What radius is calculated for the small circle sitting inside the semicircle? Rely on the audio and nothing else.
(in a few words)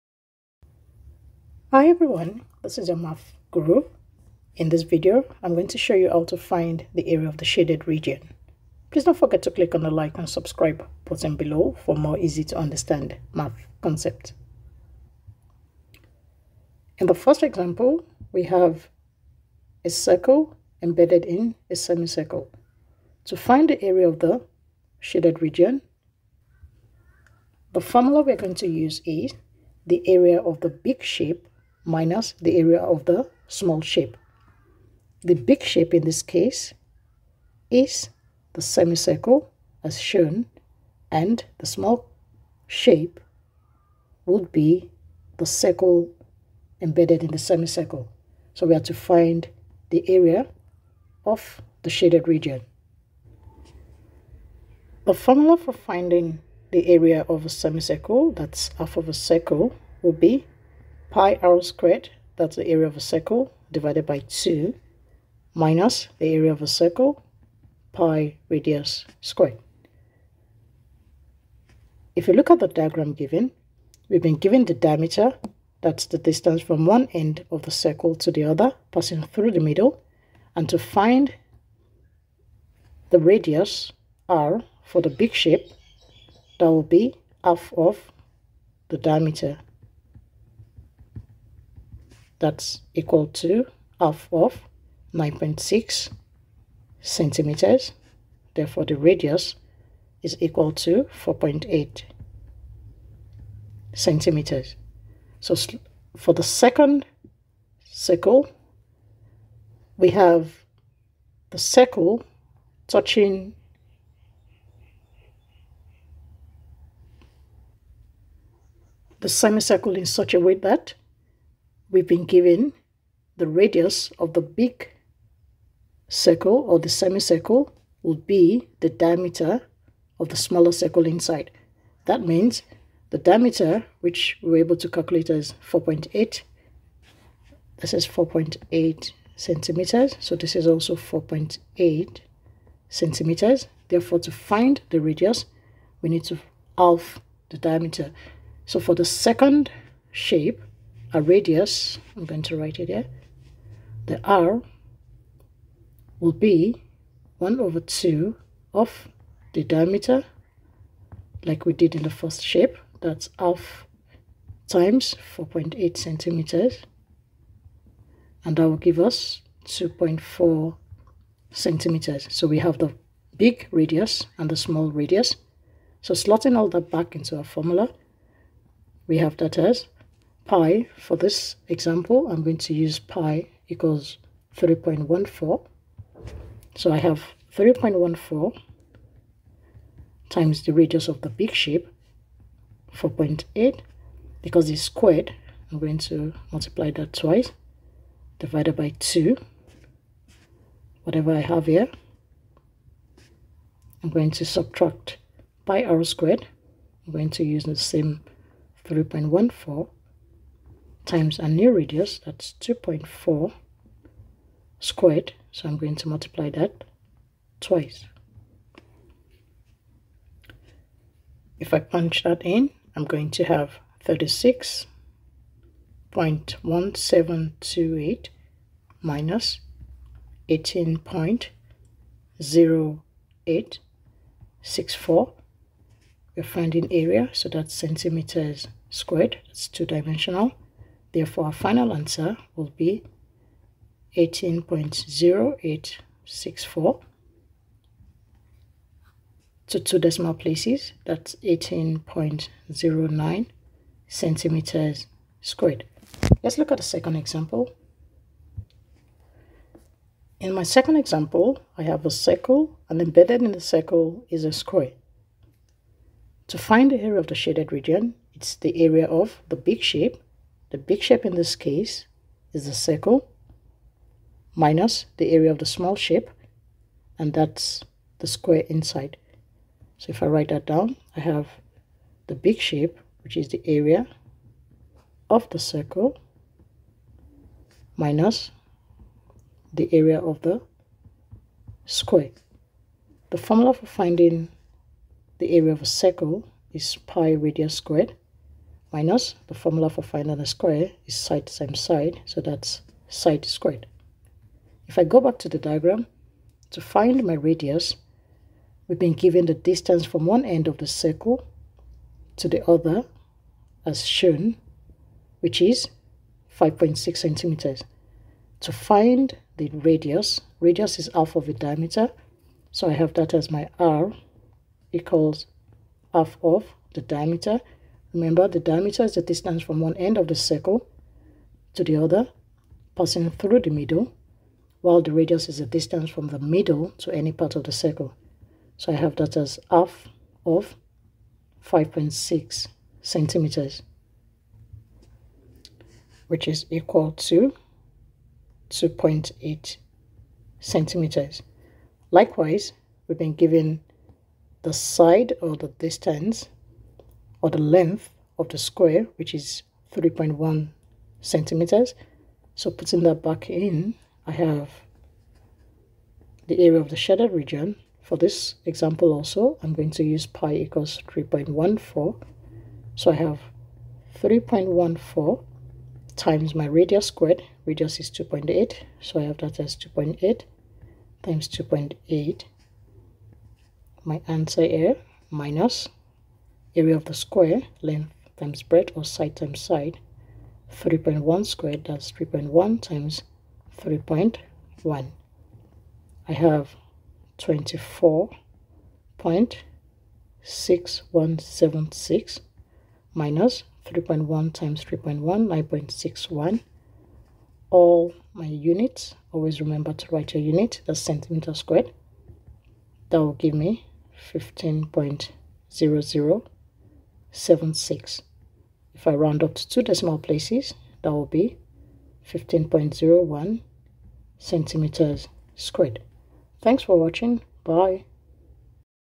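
2.4 cm.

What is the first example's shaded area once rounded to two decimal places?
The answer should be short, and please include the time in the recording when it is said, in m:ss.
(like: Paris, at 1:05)
18.09 cm², at 4:11.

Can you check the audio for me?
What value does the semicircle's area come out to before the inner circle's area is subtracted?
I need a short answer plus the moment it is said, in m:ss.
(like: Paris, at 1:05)
36.1728, at 3:44.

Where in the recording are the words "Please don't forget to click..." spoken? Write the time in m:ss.
0:08.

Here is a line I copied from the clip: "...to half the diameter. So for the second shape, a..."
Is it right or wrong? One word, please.
right.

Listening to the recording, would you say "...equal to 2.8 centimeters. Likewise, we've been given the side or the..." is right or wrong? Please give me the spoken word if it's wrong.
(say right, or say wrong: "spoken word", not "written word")
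right.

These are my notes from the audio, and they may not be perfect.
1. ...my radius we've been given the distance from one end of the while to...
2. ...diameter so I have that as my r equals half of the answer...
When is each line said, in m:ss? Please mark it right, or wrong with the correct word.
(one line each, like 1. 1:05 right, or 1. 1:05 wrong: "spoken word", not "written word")
1. 5:07 wrong: "circle", not "while"
2. 5:21 wrong: "diameter", not "answer".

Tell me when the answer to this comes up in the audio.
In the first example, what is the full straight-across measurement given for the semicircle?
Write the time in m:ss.
1:35.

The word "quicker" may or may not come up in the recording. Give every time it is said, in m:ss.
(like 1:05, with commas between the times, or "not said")
not said.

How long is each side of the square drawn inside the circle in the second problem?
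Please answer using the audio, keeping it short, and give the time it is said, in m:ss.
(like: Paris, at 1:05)
3.1 cm, at 5:59.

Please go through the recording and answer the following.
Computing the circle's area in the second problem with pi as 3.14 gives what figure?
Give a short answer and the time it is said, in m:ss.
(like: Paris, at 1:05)
24.6176, at 6:37.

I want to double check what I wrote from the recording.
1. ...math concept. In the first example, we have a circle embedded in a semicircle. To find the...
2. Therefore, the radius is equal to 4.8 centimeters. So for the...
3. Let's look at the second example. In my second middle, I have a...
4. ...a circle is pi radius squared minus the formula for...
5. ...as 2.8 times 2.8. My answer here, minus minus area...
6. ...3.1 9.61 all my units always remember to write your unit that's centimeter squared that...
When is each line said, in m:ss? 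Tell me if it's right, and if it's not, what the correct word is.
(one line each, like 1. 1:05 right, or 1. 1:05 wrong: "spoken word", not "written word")
1. 0:13 right
2. 1:38 right
3. 4:16 wrong: "example", not "middle"
4. 4:55 right
5. 6:19 right
6. 6:44 right.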